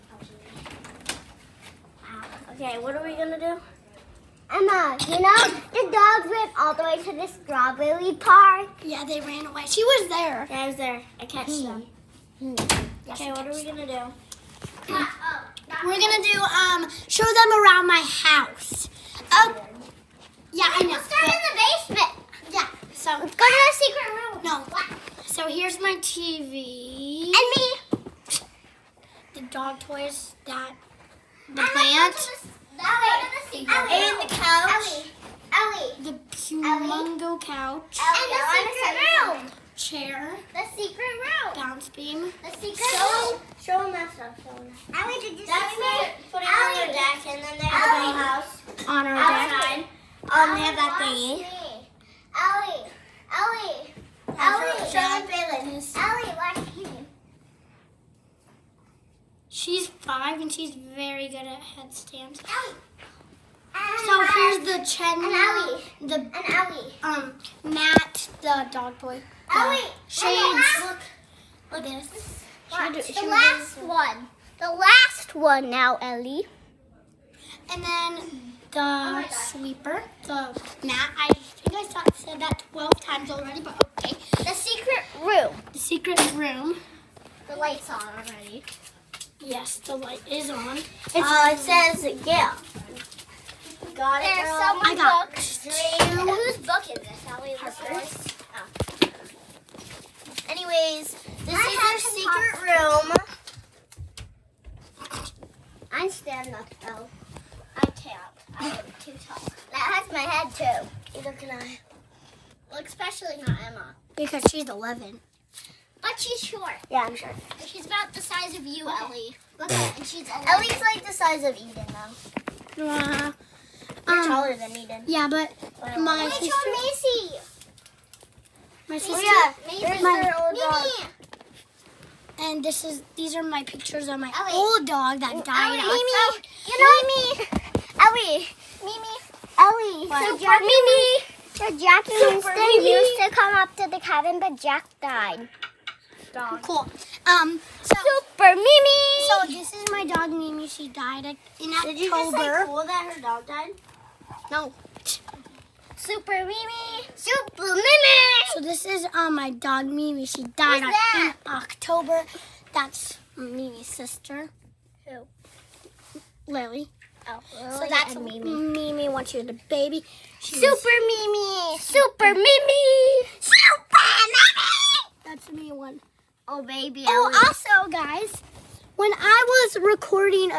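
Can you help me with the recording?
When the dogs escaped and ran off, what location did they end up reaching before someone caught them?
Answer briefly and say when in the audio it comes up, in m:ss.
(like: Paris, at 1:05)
Strawberry Park, at 0:07.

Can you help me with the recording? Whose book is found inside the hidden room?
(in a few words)
Ellie Harper.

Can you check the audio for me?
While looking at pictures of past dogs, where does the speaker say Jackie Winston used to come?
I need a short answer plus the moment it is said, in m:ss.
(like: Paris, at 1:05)
The cabin, at 2:23.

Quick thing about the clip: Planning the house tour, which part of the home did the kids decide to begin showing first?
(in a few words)
The basement.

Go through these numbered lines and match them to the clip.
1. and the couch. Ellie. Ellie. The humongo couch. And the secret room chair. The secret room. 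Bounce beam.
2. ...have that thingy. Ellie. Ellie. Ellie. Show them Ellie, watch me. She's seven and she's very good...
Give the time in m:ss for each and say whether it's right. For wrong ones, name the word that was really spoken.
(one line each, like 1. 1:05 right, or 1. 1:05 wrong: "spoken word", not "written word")
1. 0:33 right
2. 0:50 wrong: "five", not "seven".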